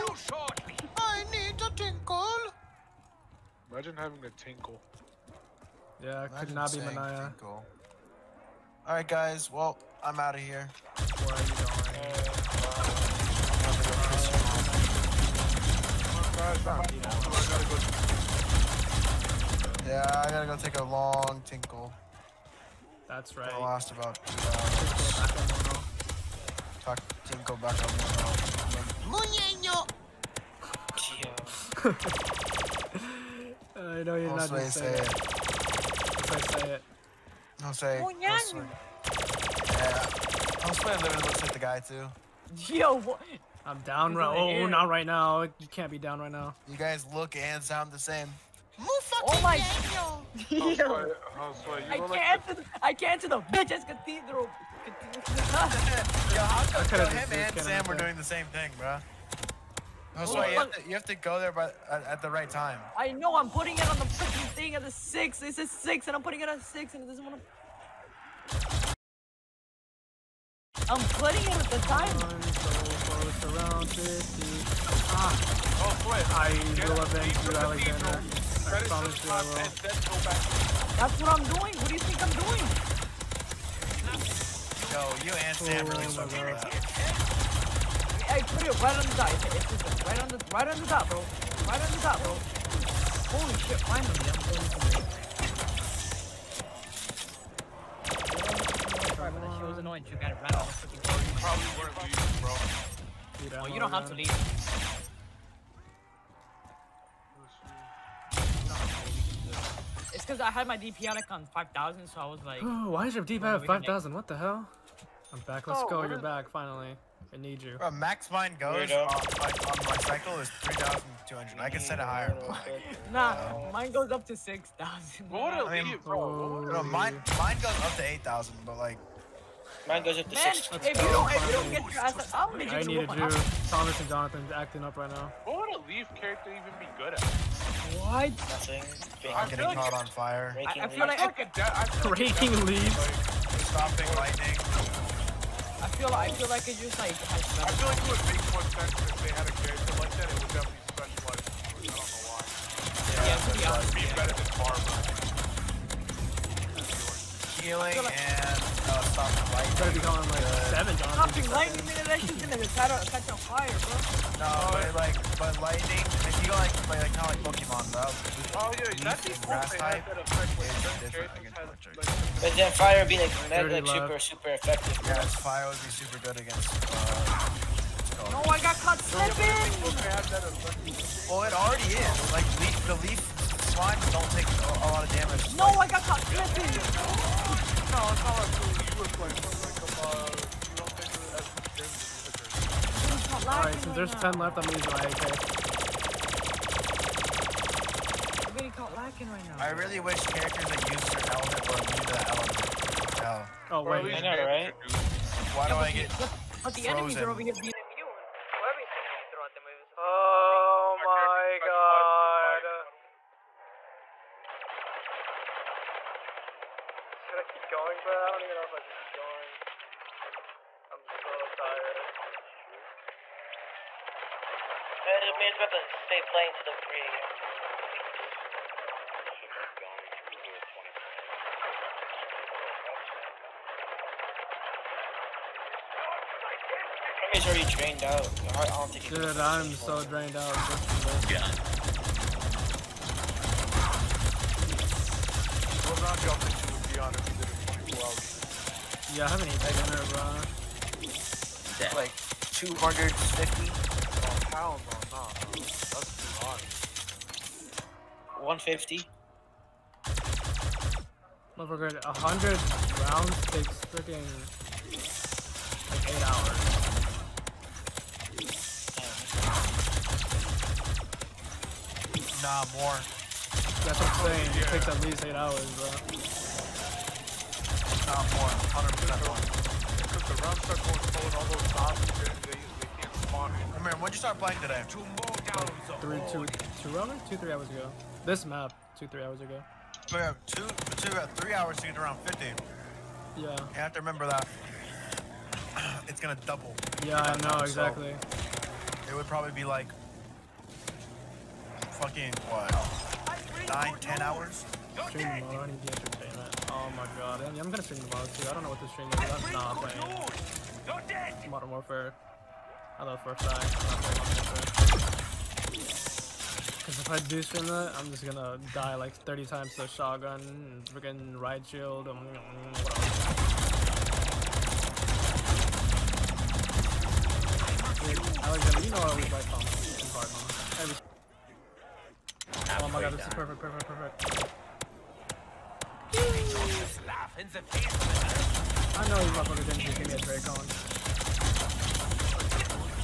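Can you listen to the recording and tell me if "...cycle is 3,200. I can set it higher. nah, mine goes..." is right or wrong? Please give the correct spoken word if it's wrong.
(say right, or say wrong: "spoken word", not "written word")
right.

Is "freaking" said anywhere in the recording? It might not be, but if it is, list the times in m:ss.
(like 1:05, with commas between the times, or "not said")
1:04, 1:40, 4:23, 5:20.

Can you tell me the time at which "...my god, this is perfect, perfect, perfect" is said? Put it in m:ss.
5:32.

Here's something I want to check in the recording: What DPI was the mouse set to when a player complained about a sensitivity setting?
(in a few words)
5,000.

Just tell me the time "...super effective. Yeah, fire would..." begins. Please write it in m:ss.
2:54.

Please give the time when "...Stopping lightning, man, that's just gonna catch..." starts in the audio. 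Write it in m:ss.
2:41.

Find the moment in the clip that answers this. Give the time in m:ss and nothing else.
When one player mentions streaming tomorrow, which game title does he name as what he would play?
5:11.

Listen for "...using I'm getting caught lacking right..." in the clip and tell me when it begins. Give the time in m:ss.
3:14.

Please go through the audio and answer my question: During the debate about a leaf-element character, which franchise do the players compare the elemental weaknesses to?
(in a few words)
Pokemon.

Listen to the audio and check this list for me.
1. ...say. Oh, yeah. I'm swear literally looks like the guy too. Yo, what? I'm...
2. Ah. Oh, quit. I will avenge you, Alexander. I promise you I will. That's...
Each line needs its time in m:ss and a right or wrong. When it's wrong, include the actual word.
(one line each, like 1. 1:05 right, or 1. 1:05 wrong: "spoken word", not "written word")
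1. 0:37 right
2. 1:15 right.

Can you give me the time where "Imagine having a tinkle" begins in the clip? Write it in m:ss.
0:03.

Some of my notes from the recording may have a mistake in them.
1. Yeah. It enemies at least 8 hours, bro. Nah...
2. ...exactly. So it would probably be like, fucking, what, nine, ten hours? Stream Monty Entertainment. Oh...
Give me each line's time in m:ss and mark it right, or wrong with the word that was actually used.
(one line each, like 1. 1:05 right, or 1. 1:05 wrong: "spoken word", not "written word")
1. 4:34 wrong: "takes", not "enemies"
2. 4:57 right.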